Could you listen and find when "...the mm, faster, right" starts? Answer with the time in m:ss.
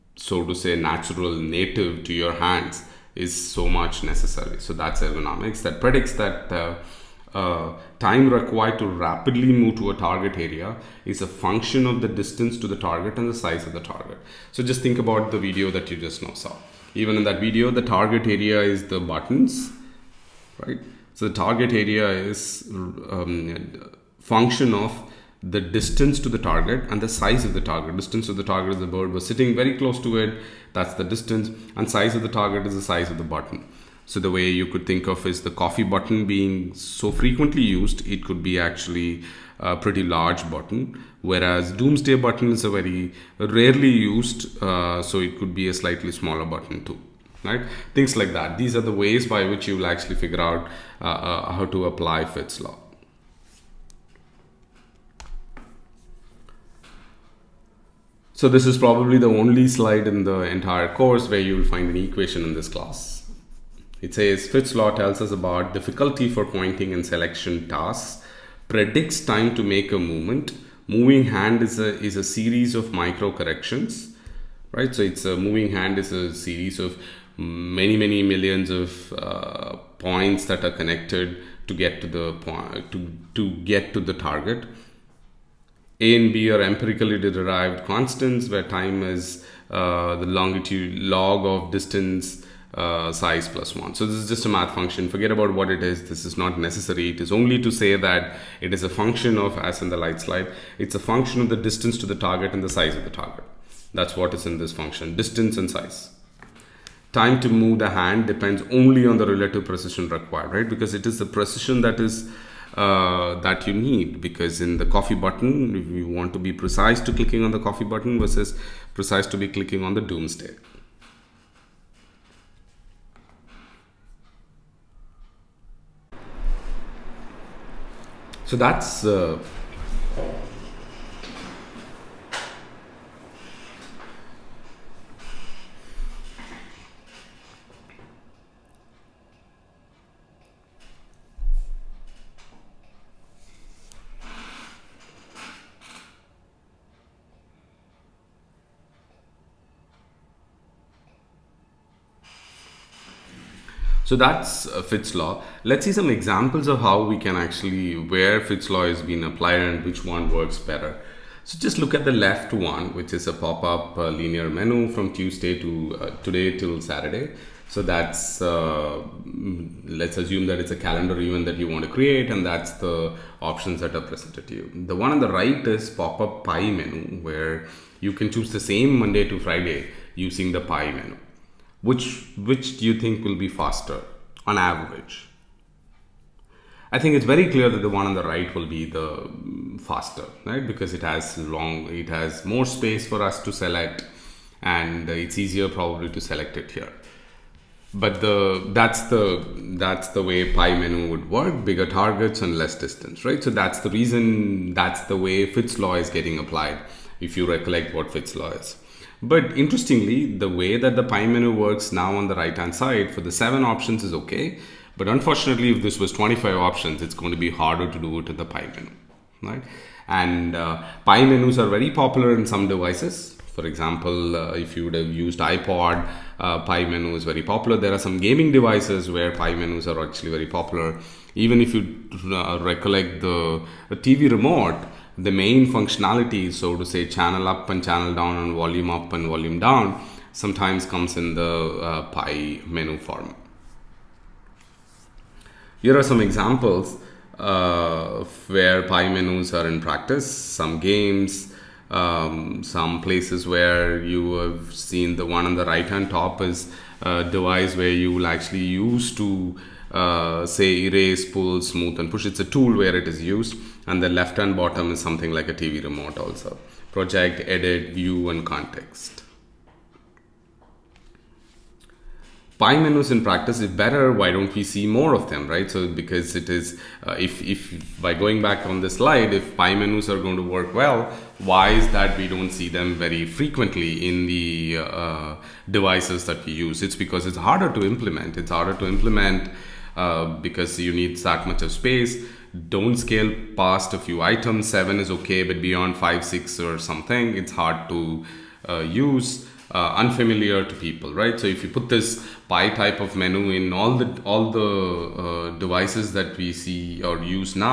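3:08.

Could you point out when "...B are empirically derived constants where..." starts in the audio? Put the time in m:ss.
1:26.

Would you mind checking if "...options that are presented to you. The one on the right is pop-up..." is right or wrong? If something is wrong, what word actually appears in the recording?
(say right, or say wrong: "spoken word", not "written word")
right.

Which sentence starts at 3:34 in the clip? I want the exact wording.
But unfortunately, if this was 25 options, it's going to be harder to do it in the pie menu, right?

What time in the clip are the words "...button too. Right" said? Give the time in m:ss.
0:46.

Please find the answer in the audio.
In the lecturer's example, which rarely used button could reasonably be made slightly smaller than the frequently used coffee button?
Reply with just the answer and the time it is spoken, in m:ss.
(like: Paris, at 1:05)
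Doomsday button, at 0:41.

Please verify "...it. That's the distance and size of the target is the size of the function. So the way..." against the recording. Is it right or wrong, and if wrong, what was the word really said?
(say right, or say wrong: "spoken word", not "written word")
wrong: "button", not "function".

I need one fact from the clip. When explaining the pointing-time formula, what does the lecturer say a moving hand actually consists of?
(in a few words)
Micro corrections.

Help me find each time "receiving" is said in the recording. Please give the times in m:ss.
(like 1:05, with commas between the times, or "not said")
not said.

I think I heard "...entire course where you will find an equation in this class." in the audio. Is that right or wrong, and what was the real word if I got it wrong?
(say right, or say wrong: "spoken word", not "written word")
right.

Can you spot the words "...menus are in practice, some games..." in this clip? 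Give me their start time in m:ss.
4:09.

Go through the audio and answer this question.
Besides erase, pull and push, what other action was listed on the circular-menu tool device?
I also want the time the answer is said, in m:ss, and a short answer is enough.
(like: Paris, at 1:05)
Smooth, at 4:21.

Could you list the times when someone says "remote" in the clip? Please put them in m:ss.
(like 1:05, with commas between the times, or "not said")
3:54, 4:25.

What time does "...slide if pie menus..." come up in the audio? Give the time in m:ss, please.
4:38.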